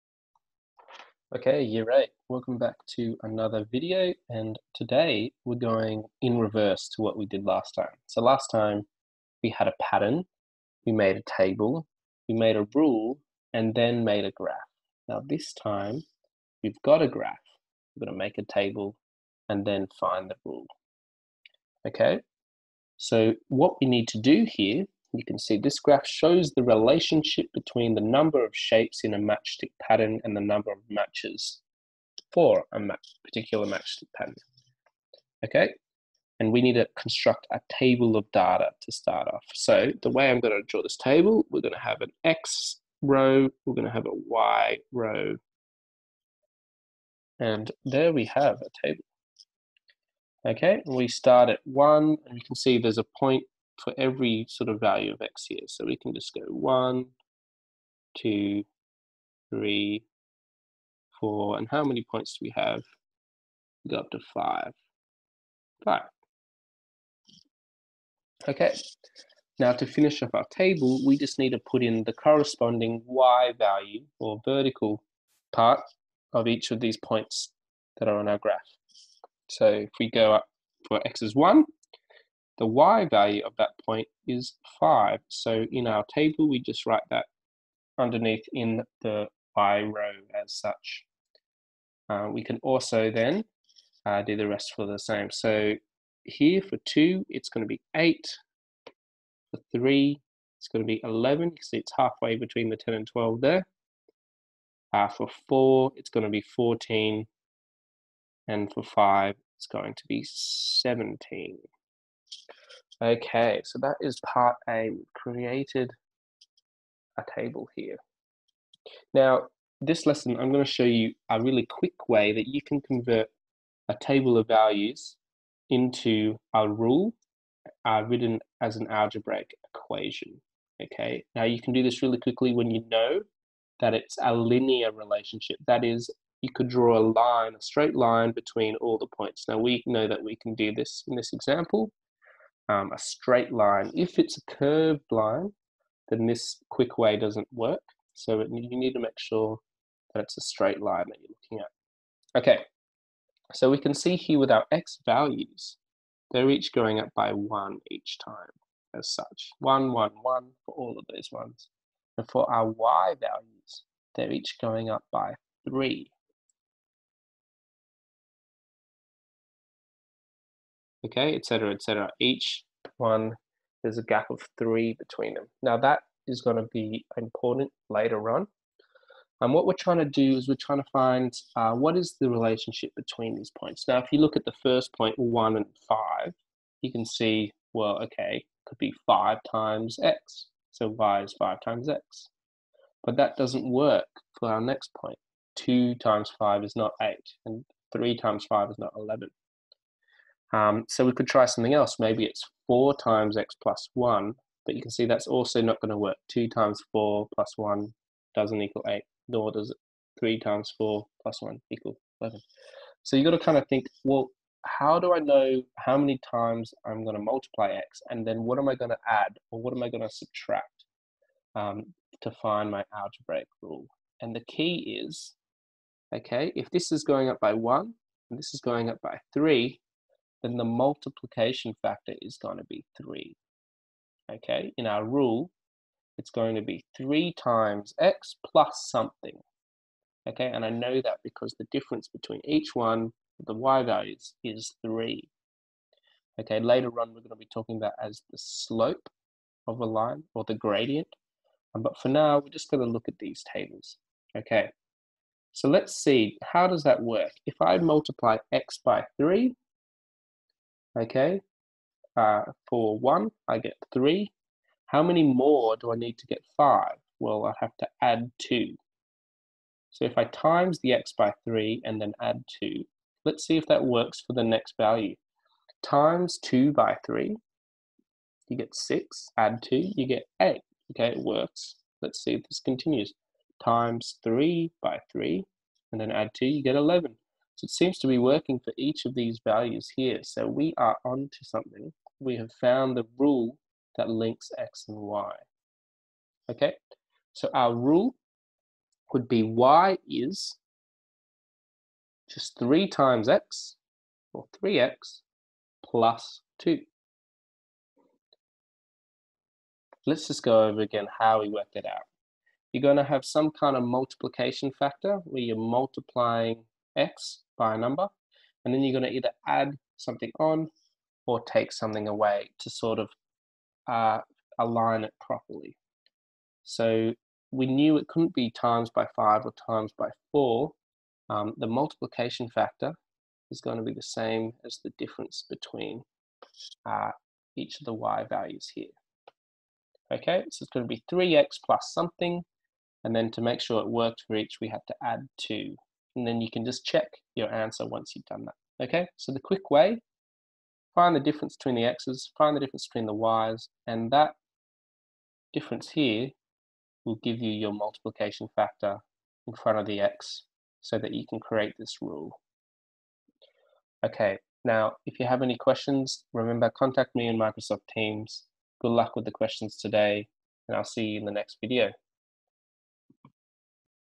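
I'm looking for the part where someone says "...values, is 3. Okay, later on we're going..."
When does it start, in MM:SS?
04:03.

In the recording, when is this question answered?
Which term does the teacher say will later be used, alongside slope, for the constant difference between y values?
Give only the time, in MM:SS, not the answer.
04:10.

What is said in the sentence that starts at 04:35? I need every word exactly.
Times two by three, you get six, add two, you get eight.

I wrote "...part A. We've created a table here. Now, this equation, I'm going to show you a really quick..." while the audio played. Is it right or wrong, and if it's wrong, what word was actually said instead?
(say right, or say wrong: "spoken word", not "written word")
wrong: "lesson", not "equation".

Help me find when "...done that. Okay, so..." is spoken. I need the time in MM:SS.
05:48.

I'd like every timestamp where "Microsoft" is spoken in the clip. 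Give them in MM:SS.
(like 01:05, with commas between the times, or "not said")
06:07.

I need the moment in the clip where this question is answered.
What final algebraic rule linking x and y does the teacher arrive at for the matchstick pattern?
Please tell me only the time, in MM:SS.
05:04.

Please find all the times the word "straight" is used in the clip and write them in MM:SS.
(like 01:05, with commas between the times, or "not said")
02:17, 02:22, 02:30.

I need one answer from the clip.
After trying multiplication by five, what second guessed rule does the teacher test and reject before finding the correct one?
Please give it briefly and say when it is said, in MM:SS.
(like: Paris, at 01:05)
4 times x plus 1, at 03:22.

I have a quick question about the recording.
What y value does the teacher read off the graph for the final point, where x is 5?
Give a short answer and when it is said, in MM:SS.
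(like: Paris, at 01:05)
17, at 01:48.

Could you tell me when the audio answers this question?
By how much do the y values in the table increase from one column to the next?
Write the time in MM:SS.
02:44.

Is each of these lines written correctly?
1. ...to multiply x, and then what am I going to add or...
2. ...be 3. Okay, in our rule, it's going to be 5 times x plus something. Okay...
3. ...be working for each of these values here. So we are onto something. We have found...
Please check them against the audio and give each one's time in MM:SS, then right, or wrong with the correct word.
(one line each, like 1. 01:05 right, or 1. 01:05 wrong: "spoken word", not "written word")
1. 03:37 right
2. 03:52 wrong: "3", not "5"
3. 04:48 right.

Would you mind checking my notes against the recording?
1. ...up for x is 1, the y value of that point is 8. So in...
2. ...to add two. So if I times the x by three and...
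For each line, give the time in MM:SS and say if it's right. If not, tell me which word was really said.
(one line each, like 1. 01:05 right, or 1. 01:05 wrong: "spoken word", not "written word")
1. 01:20 wrong: "5", not "8"
2. 04:27 right.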